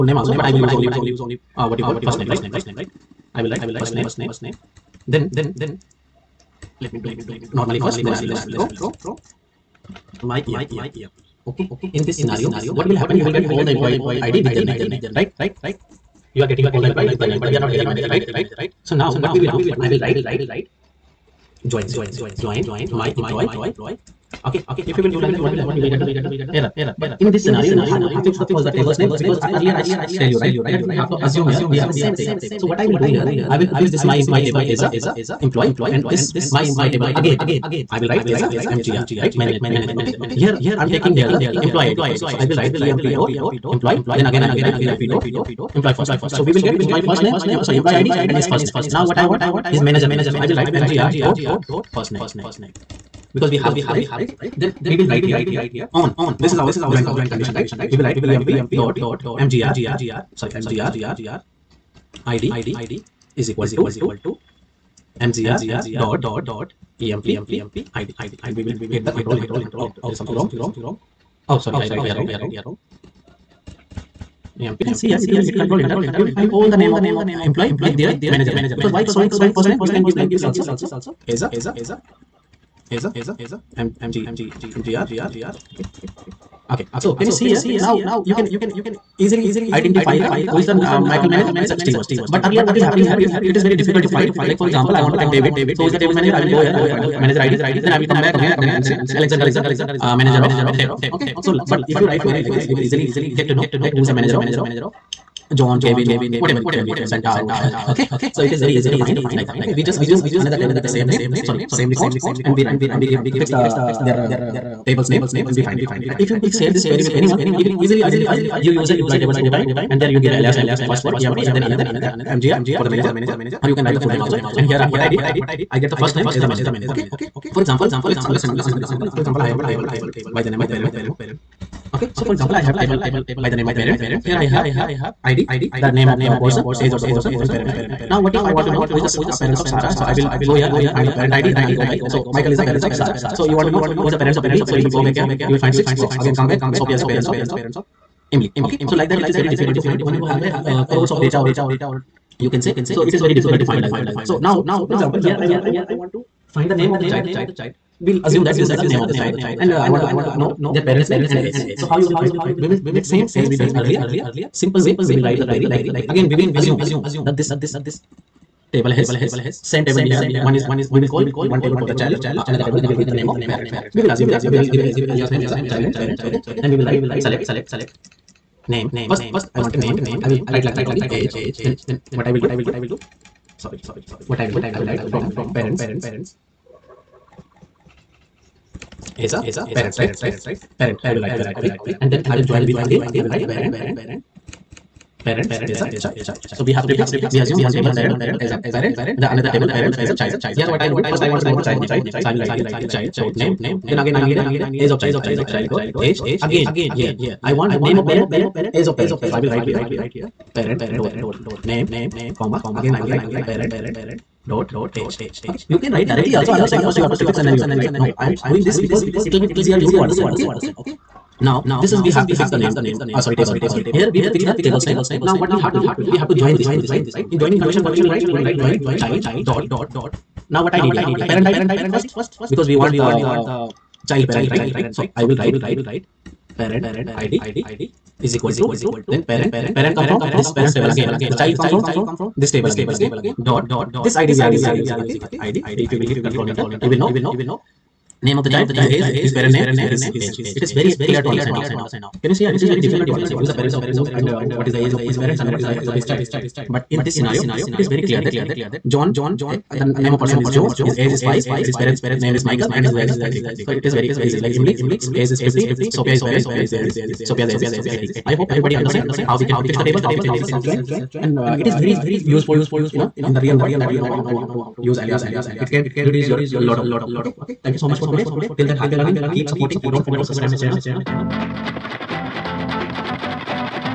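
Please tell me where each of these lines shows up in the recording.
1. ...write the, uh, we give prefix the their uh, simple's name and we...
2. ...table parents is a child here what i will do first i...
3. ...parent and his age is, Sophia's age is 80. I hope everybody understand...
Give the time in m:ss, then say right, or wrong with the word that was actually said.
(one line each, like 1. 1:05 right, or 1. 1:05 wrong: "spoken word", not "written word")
1. 1:52 wrong: "table", not "simple"
2. 3:19 right
3. 4:26 right.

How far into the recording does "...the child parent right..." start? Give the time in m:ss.
3:53.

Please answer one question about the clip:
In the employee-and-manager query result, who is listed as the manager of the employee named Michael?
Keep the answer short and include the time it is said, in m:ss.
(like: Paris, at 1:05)
Steven, at 1:31.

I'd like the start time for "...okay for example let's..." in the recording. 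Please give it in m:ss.
2:06.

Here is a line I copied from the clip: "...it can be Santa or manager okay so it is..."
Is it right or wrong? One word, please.
wrong.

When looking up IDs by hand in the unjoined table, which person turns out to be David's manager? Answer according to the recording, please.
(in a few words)
Alexander.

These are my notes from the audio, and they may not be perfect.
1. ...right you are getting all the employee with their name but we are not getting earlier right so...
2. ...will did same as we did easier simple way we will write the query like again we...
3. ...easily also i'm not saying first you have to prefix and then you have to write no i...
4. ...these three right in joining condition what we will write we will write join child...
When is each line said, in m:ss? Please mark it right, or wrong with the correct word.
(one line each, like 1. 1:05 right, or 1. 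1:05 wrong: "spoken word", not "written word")
1. 0:15 wrong: "manager", not "earlier"
2. 2:42 wrong: "earlier", not "easier"
3. 3:36 wrong: "directly", not "easily"
4. 3:46 wrong: "two", not "three".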